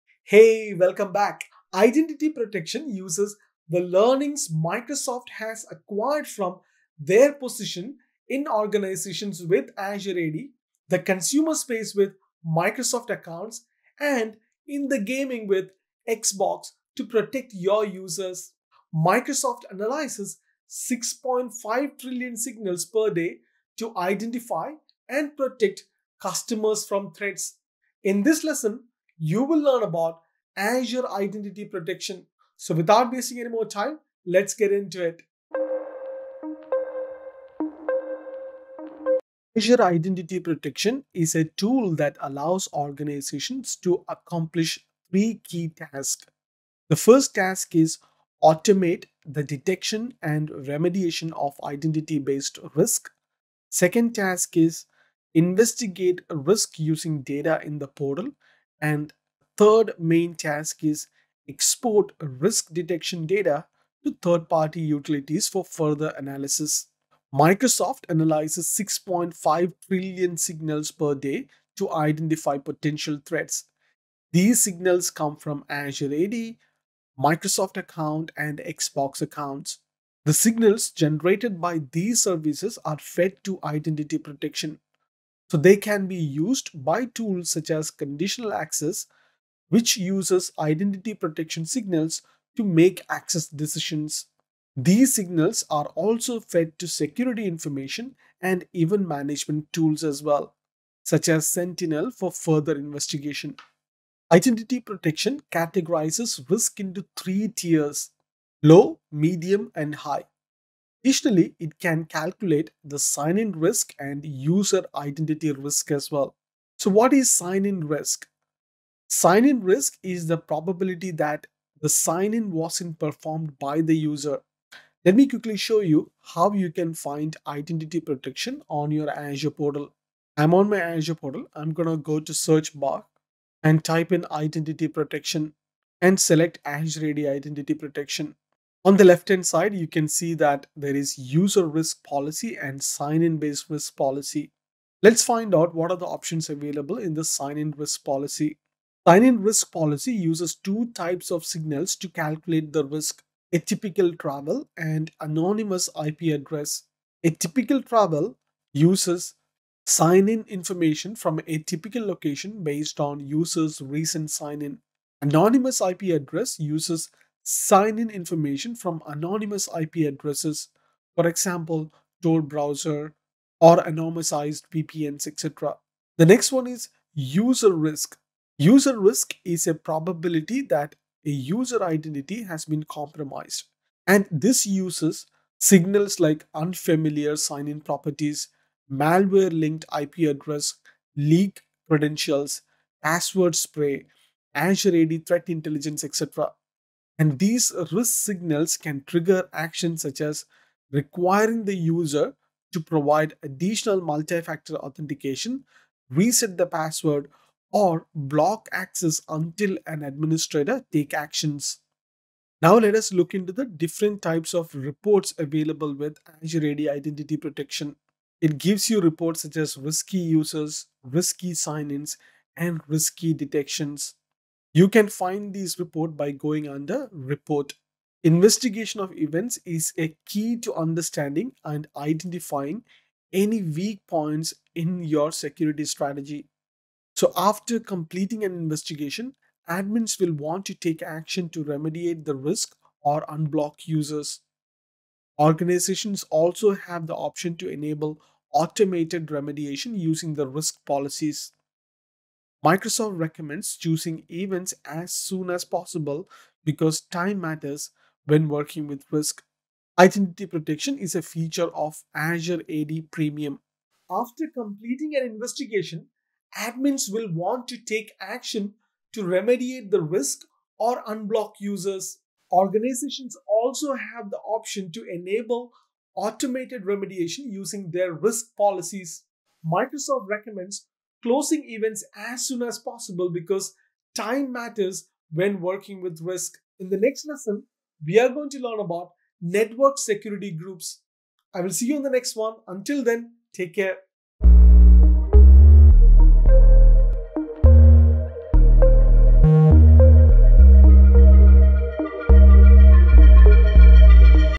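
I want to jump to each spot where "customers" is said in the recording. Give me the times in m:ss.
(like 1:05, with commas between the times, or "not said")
0:26.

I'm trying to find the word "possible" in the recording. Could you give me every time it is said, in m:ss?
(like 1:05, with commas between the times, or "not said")
4:15, 4:42.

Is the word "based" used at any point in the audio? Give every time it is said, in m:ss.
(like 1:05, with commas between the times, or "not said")
0:51, 2:23, 2:42.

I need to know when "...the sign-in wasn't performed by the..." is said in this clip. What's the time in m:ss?
2:01.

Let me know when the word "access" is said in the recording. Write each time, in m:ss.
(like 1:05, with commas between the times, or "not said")
1:28, 1:33, 3:28.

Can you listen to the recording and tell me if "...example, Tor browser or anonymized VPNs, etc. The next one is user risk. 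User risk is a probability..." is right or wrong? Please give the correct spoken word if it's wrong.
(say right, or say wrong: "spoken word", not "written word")
right.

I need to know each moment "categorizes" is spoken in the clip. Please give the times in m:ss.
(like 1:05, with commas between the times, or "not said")
1:45.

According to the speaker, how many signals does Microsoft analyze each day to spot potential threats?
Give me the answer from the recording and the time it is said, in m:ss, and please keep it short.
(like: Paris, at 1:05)
6.5 trillion, at 0:20.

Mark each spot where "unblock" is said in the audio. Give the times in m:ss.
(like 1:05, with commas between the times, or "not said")
4:03, 4:31.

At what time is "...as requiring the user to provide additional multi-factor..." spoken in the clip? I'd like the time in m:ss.
3:20.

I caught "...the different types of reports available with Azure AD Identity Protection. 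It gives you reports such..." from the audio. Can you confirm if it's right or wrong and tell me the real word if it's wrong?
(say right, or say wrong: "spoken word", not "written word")
right.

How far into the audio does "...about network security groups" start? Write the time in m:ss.
4:48.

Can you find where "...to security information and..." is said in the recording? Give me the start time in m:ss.
1:36.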